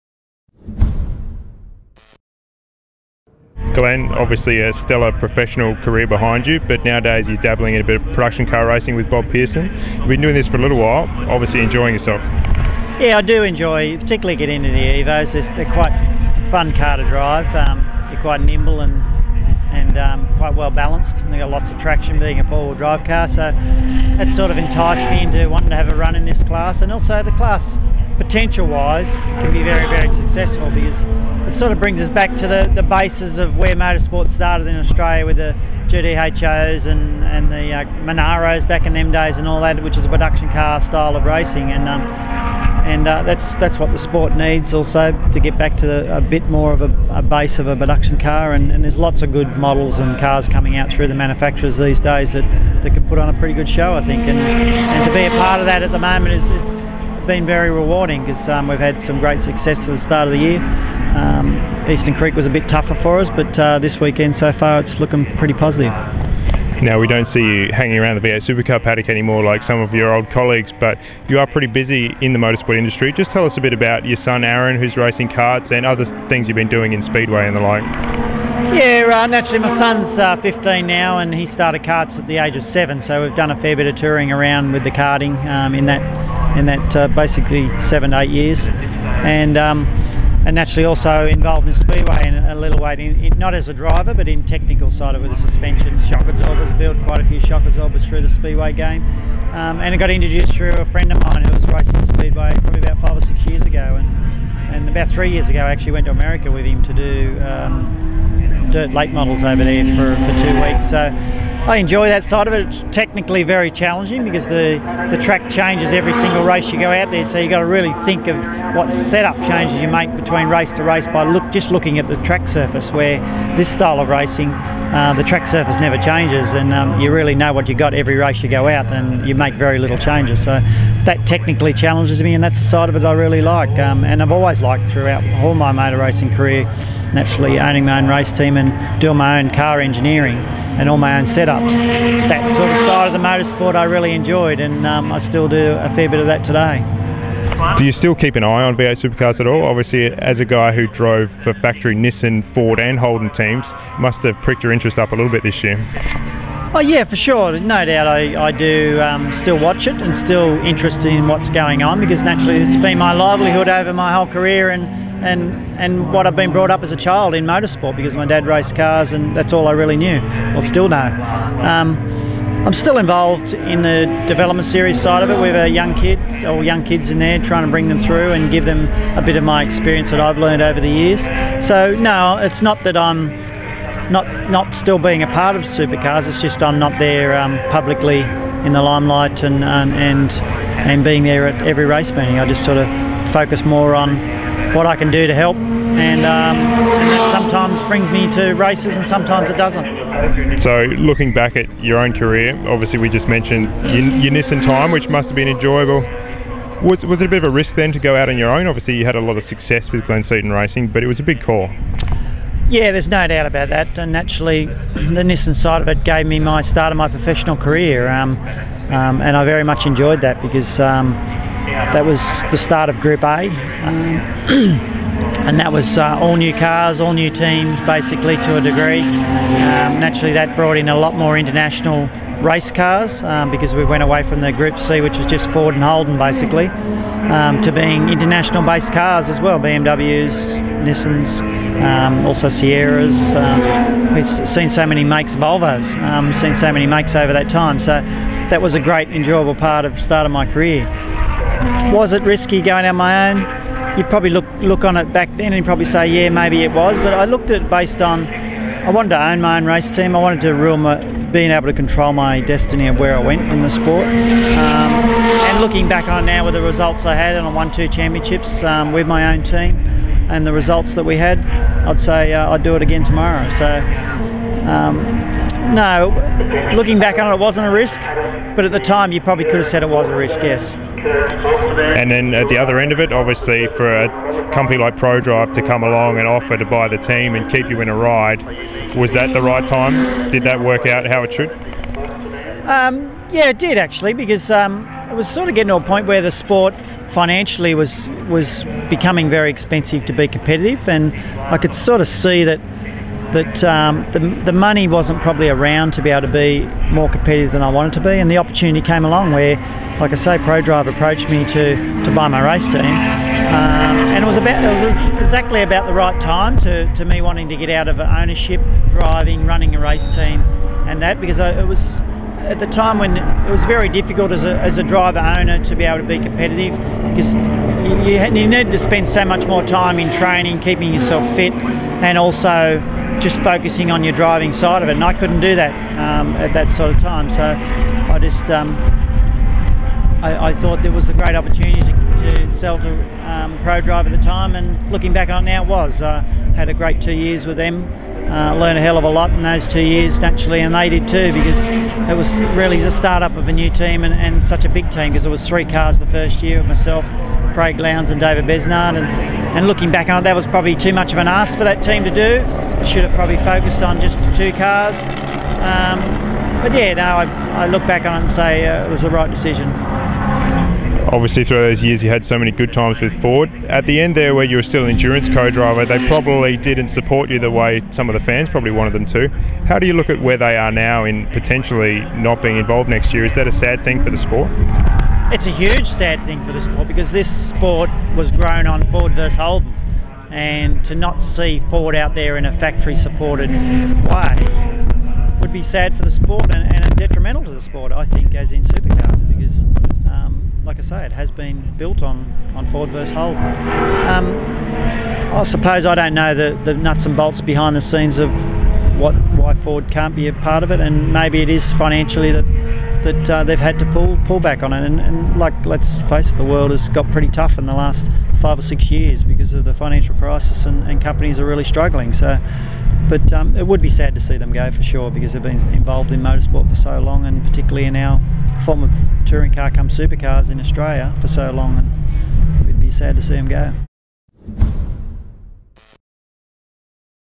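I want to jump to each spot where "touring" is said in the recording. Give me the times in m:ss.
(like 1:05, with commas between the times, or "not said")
1:23, 7:09.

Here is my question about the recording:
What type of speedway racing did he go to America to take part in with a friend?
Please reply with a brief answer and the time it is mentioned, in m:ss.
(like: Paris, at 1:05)
Dirt late models, at 1:48.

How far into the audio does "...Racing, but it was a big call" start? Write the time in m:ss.
3:30.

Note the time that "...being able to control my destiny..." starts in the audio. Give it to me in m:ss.
4:21.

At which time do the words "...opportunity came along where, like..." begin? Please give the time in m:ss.
5:08.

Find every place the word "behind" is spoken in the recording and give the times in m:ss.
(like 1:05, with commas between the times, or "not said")
0:06, 6:47.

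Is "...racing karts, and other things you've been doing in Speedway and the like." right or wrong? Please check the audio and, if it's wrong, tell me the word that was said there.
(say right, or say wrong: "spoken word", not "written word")
right.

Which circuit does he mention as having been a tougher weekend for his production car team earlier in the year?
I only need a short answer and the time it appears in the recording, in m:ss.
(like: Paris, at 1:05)
Eastern Creek, at 1:01.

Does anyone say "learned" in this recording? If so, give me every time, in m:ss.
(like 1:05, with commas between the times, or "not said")
3:00, 5:48.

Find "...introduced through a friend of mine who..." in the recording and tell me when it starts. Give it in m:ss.
1:40.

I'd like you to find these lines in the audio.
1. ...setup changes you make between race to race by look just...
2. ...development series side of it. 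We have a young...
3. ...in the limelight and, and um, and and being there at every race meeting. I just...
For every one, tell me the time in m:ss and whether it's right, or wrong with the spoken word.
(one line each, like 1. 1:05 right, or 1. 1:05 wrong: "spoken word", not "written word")
1. 1:58 right
2. 2:54 right
3. 3:08 right.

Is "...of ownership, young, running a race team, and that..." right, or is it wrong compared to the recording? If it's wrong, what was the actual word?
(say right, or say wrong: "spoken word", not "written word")
wrong: "driving", not "young".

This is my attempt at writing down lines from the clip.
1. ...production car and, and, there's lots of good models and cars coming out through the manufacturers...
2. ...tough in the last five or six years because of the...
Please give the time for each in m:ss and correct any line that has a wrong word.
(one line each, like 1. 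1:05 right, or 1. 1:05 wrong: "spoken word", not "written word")
1. 0:47 right
2. 6:57 right.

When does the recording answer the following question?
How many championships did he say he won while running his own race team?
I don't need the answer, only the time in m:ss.
4:27.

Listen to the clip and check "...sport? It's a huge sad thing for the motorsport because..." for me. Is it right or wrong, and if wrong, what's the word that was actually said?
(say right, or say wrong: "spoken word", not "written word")
wrong: "sport", not "motorsport".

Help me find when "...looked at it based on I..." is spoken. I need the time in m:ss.
4:17.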